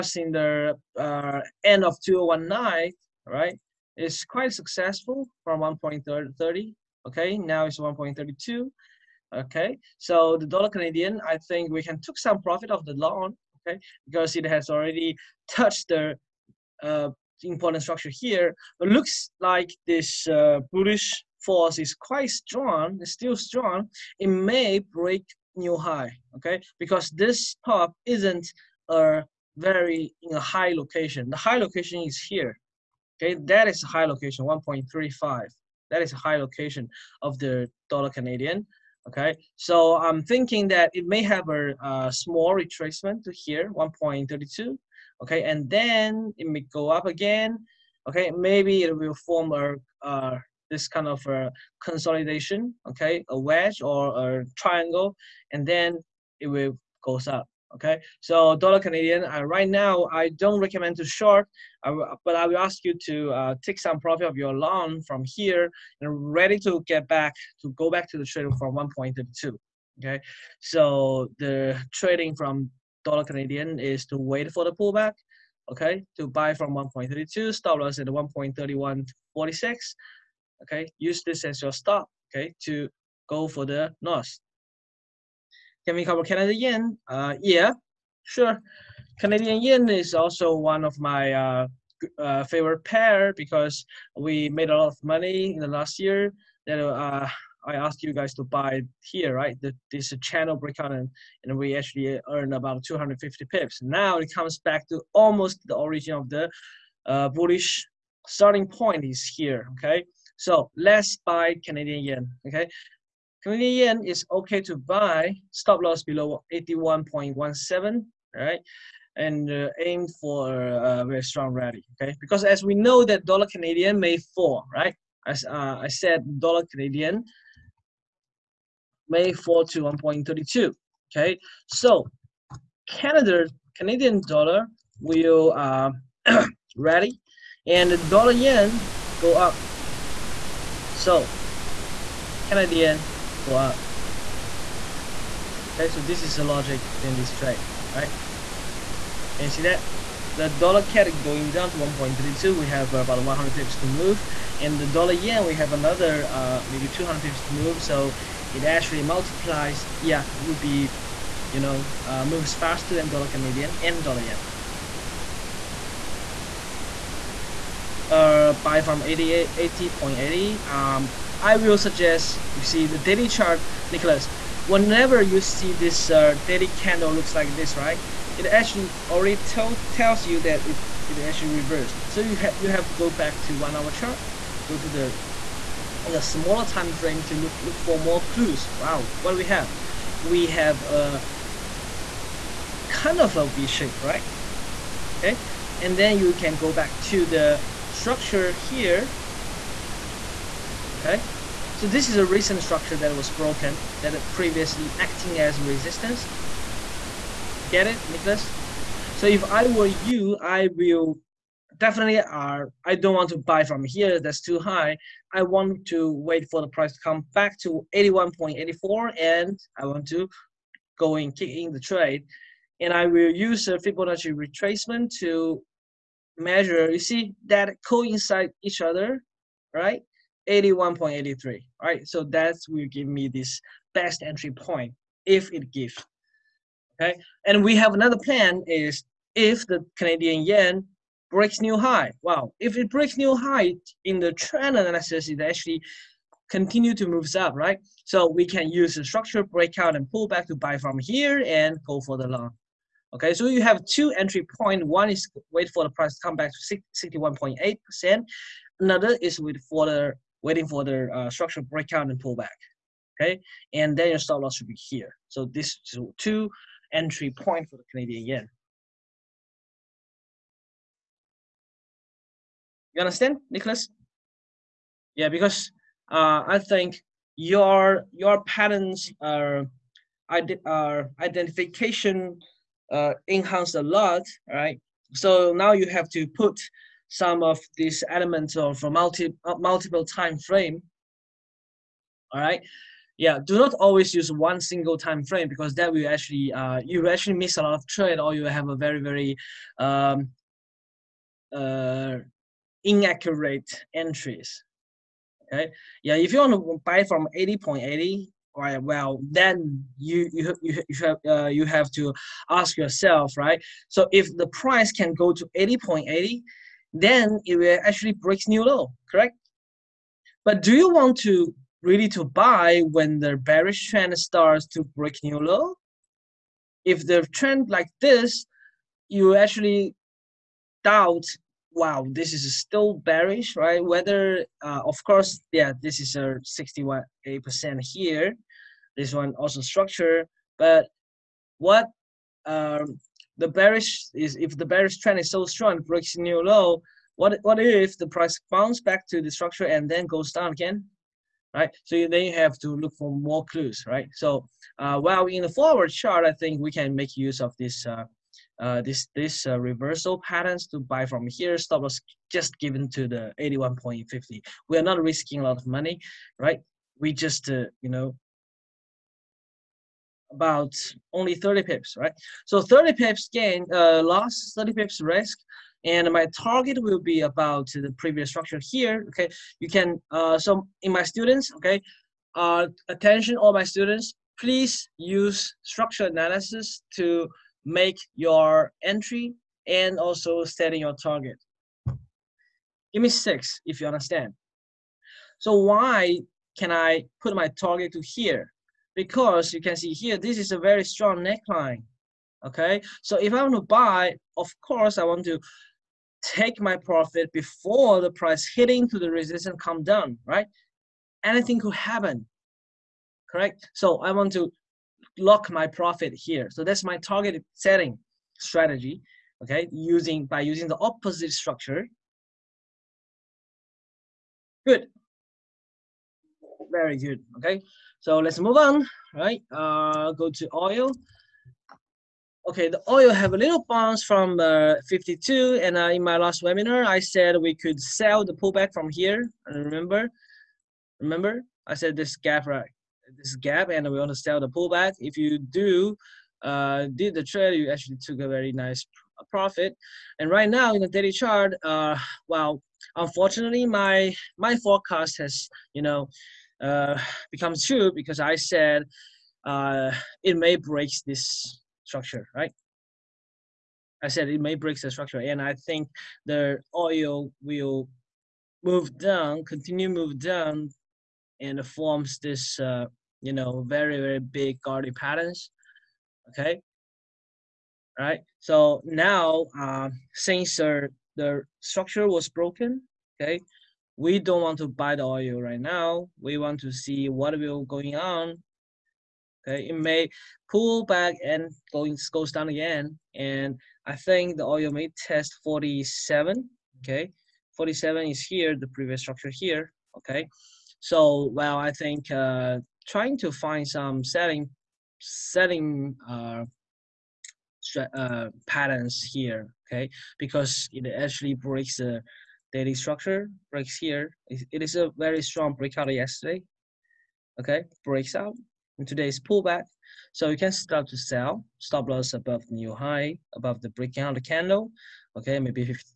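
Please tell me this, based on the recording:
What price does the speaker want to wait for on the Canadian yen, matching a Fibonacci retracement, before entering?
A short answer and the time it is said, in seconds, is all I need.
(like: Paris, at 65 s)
81.84, at 217 s.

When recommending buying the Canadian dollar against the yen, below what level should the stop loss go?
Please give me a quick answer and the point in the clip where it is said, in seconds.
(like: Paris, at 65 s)
81.17, at 116 s.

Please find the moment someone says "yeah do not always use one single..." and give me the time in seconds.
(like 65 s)
293 s.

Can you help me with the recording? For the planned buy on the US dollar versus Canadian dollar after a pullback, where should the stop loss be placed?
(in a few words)
1.3146.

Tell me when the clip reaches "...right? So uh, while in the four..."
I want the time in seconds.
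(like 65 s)
353 s.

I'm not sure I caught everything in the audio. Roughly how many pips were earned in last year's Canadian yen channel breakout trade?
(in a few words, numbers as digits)
250 pips.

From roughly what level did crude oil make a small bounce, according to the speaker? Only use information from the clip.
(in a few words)
52.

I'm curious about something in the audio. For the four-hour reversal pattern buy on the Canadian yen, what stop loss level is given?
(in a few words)
81.50.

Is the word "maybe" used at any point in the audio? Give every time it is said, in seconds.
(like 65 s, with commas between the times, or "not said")
48 s, 156 s, 525 s.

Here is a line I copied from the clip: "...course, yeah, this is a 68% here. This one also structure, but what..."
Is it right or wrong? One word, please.
right.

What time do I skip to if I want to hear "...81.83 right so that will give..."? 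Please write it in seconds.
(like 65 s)
230 s.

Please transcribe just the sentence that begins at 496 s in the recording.
Okay, 47 is here, the previous structure here.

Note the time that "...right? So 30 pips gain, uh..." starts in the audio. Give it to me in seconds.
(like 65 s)
371 s.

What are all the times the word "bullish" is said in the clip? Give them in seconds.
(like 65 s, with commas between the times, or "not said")
20 s, 107 s.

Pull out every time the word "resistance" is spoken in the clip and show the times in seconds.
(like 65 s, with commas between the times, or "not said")
205 s, 409 s.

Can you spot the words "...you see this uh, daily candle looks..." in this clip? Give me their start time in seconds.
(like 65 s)
175 s.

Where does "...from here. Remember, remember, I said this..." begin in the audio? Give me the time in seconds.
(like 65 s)
438 s.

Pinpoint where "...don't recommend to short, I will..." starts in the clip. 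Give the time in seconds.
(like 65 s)
60 s.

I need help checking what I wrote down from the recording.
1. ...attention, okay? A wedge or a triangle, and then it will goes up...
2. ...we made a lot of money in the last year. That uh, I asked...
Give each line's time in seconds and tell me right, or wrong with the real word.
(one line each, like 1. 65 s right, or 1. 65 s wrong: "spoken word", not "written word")
1. 51 s wrong: "consolidation", not "attention"
2. 94 s right.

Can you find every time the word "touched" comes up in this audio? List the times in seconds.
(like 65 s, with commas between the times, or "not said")
15 s.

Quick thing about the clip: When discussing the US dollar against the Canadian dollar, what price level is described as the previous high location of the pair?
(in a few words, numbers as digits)
1.35.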